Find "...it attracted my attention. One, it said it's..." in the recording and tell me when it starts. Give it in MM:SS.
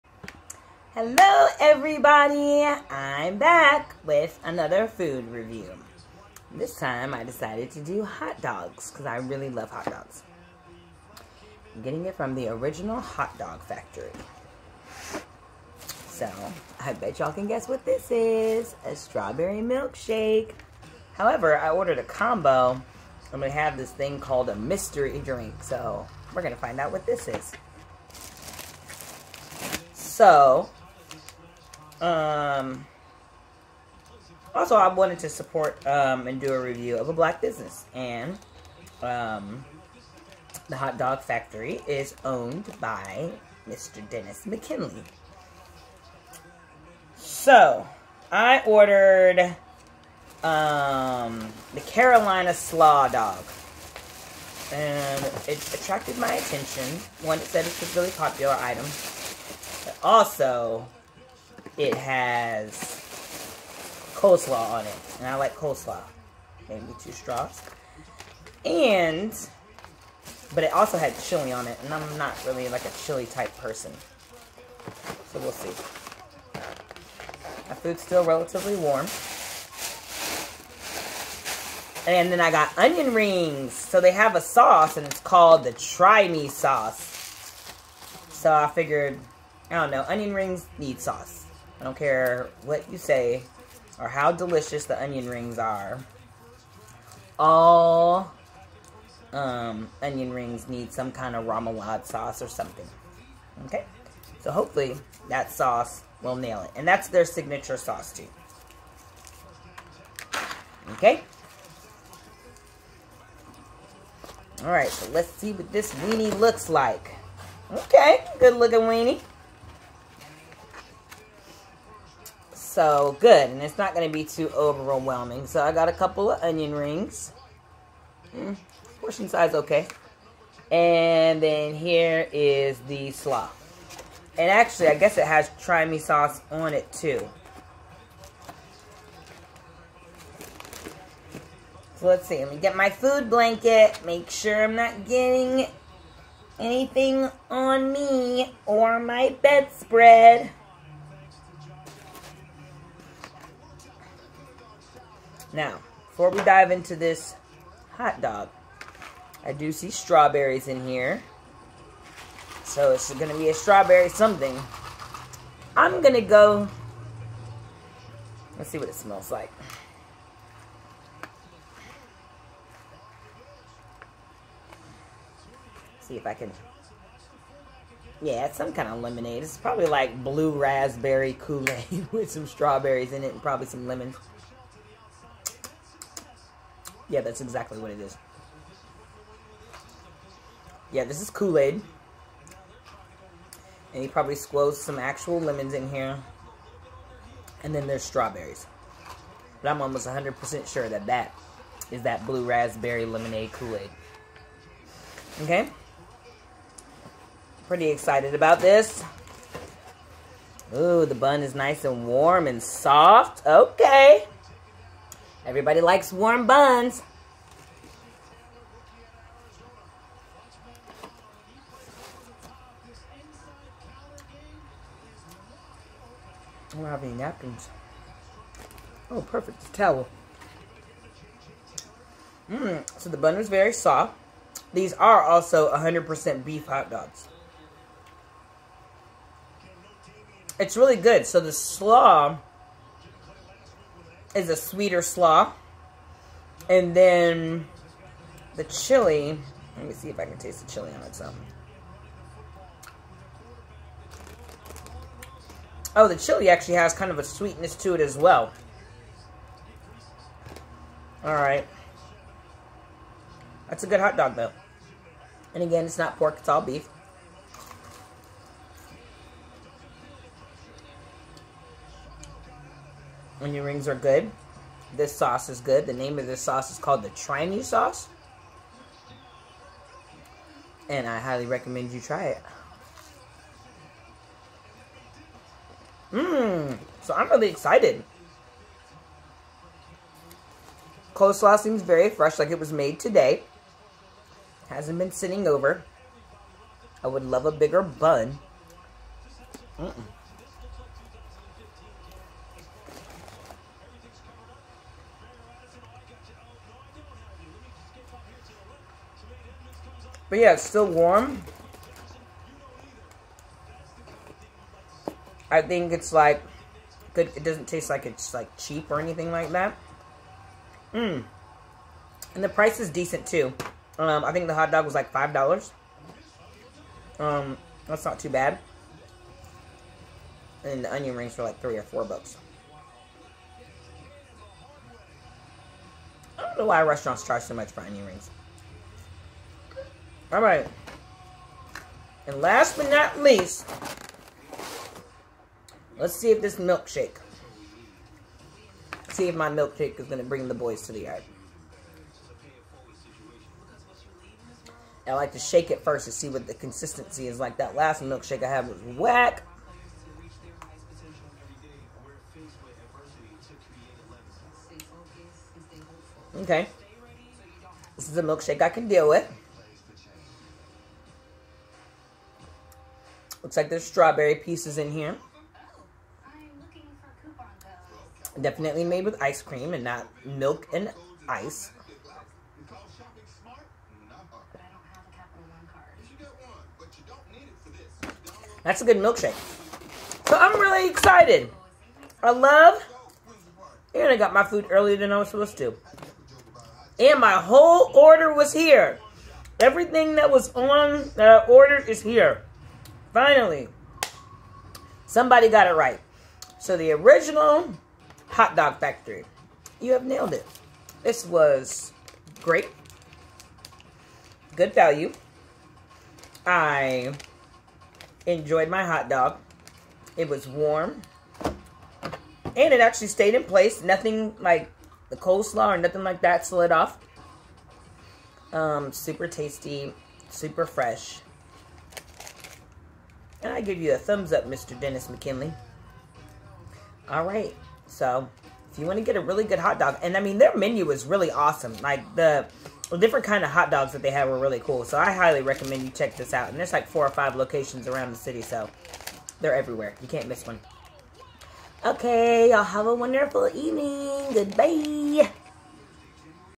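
00:55.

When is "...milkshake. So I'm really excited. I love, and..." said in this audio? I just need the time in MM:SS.
06:28.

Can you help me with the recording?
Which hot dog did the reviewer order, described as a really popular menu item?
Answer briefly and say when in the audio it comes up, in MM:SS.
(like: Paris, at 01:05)
Carolina Slaw Dog, at 00:51.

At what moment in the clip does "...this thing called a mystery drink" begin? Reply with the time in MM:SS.
00:23.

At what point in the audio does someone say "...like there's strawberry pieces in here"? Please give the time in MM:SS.
06:13.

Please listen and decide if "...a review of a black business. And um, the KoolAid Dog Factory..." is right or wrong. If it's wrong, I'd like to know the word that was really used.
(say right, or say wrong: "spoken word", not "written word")
wrong: "Hot", not "KoolAid".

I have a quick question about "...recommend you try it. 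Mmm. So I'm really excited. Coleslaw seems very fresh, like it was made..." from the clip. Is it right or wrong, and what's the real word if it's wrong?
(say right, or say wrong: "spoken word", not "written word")
right.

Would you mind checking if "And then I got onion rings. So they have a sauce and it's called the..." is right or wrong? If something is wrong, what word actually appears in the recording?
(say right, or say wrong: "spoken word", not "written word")
right.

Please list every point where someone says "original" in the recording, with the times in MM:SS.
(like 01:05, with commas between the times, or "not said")
00:12, 06:46.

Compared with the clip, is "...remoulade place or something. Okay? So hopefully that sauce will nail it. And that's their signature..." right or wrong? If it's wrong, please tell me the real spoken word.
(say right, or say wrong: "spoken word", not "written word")
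wrong: "sauce", not "place".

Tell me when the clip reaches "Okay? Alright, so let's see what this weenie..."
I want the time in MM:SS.
01:50.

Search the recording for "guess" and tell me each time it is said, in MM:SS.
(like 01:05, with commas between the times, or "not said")
00:17, 02:14.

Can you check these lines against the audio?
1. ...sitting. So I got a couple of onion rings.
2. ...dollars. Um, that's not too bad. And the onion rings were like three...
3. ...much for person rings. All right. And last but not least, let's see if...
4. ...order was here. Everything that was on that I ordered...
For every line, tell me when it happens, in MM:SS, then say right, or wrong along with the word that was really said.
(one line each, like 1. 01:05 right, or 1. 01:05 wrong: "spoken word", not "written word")
1. 02:04 wrong: "overwhelming", not "sitting"
2. 05:25 right
3. 05:37 wrong: "onion", not "person"
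4. 06:37 right.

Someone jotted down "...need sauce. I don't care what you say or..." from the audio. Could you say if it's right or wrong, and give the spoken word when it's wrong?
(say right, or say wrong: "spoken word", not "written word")
right.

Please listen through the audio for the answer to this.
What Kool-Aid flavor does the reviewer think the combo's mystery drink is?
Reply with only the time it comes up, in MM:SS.
03:22.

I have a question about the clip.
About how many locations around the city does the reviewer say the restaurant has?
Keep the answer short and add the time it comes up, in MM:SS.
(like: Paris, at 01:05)
4 or 5, at 07:26.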